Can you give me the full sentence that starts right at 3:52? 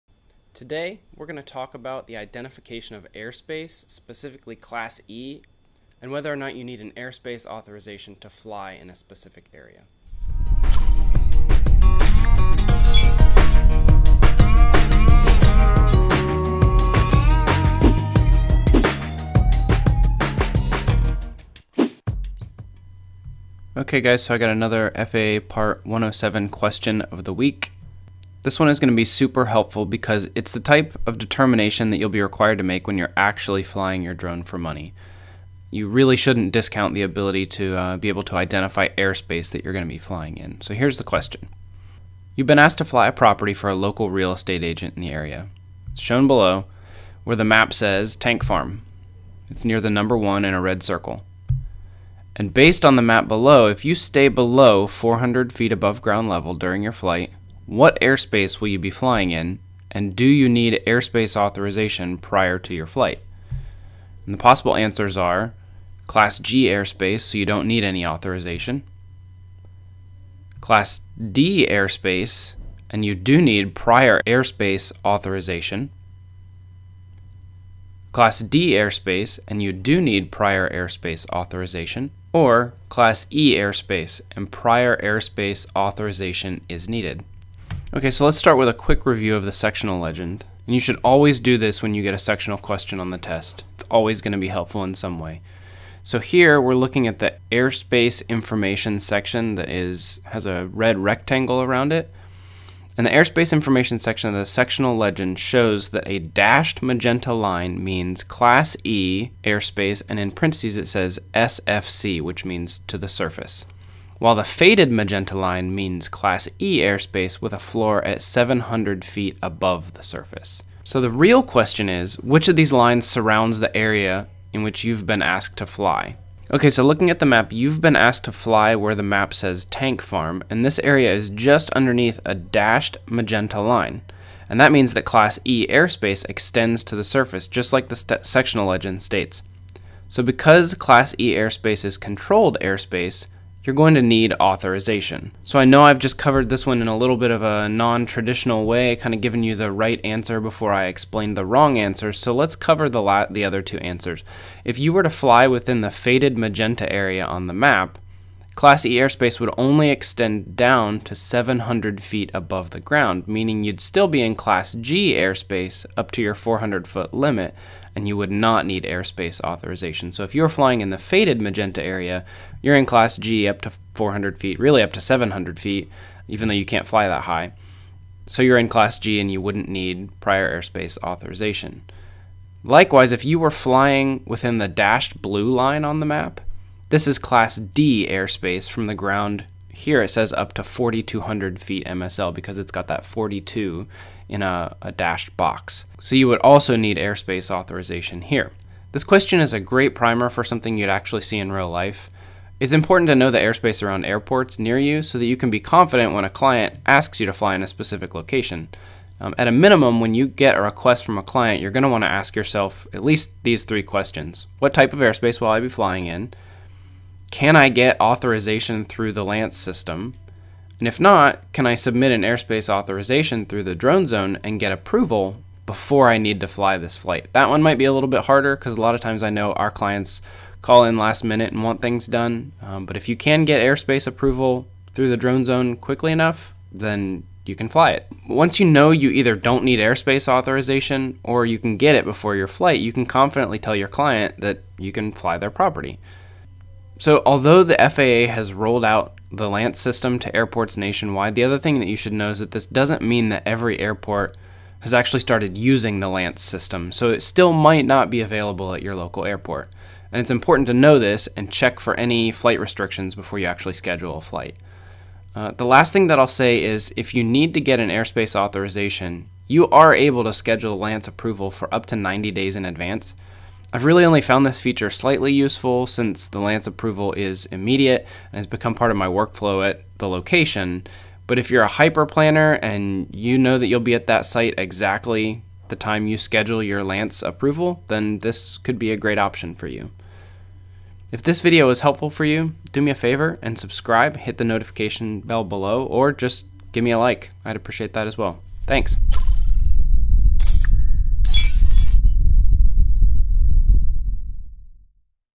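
Um, but if you can get airspace approval through the drone zone quickly enough, then you can fly it.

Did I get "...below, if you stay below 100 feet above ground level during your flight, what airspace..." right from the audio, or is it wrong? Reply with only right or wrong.
wrong.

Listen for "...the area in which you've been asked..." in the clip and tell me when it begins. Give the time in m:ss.
2:03.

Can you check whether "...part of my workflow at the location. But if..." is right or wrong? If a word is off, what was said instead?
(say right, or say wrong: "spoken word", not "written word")
right.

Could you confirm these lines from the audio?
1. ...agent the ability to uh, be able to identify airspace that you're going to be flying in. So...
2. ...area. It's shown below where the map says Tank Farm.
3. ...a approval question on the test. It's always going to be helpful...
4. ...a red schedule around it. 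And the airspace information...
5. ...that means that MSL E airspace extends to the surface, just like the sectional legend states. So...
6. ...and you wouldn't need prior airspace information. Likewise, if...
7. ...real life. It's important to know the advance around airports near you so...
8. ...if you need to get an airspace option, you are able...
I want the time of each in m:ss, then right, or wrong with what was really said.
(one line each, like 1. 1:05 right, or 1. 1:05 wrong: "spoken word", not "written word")
1. 0:36 wrong: "discount", not "agent"
2. 0:45 right
3. 1:32 wrong: "sectional", not "approval"
4. 1:40 wrong: "rectangle", not "schedule"
5. 2:14 wrong: "Class", not "MSL"
6. 2:59 wrong: "authorization", not "information"
7. 3:21 wrong: "airspace", not "advance"
8. 4:26 wrong: "authorization", not "option".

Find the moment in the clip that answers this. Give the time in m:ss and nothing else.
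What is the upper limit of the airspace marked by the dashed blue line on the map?
3:10.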